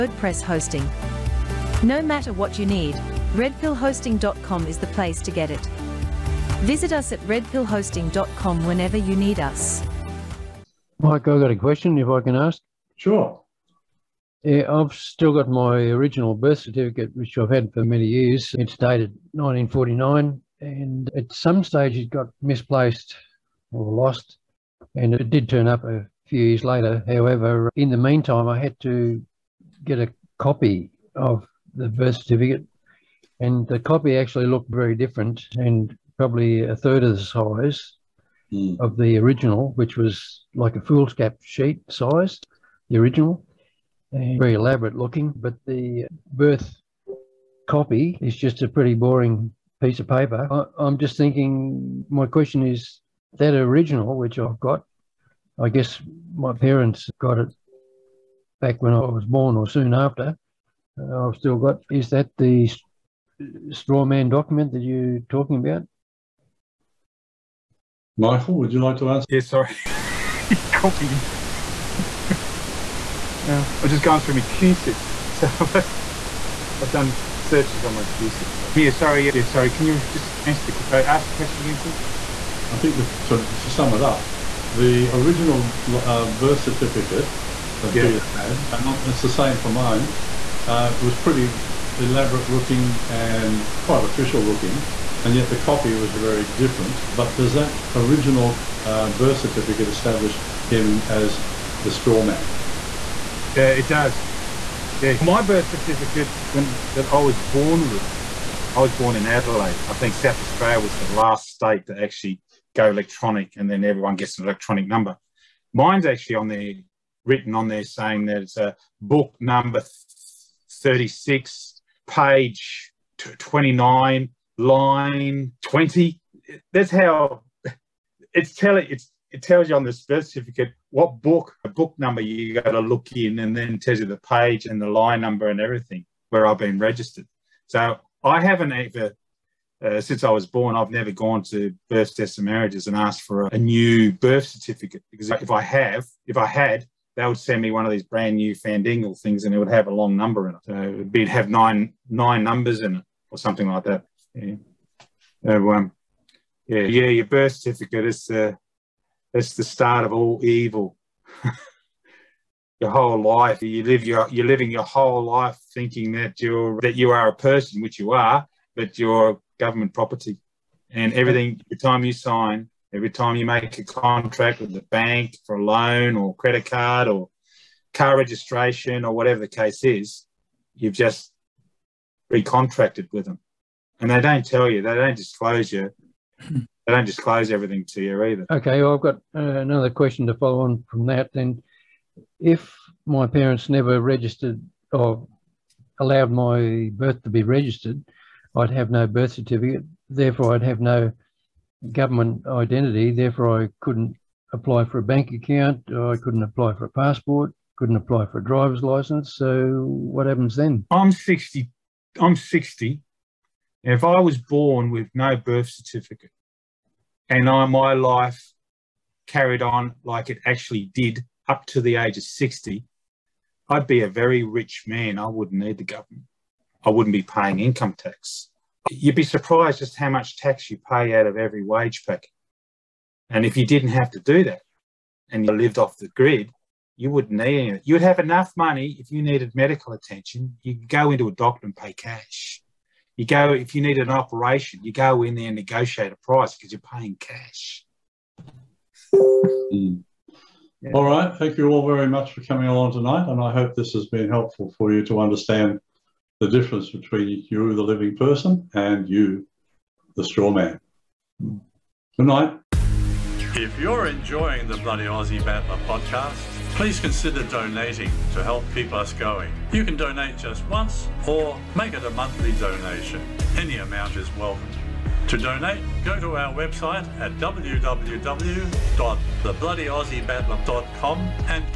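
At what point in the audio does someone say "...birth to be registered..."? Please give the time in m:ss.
3:16.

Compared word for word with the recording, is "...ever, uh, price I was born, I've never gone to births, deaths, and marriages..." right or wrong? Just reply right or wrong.
wrong.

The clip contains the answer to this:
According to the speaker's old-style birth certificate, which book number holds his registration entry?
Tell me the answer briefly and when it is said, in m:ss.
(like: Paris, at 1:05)
36, at 2:00.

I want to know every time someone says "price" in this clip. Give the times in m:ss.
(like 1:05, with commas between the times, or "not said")
4:06.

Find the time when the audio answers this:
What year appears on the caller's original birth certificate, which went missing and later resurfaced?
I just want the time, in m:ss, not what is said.
0:19.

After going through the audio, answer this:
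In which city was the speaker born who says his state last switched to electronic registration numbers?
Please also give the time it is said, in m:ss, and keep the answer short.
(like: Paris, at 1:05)
Adelaide, at 1:49.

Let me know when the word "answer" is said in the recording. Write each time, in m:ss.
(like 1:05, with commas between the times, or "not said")
1:09, 1:20.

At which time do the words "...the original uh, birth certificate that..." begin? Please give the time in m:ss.
1:24.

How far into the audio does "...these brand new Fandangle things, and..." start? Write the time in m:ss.
2:27.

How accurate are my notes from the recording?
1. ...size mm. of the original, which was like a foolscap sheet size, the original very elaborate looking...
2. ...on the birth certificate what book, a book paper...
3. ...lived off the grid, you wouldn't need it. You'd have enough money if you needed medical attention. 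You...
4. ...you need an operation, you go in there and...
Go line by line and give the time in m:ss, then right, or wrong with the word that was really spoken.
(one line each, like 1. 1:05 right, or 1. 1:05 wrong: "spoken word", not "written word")
1. 0:37 right
2. 2:09 wrong: "number", not "paper"
3. 3:55 right
4. 4:03 right.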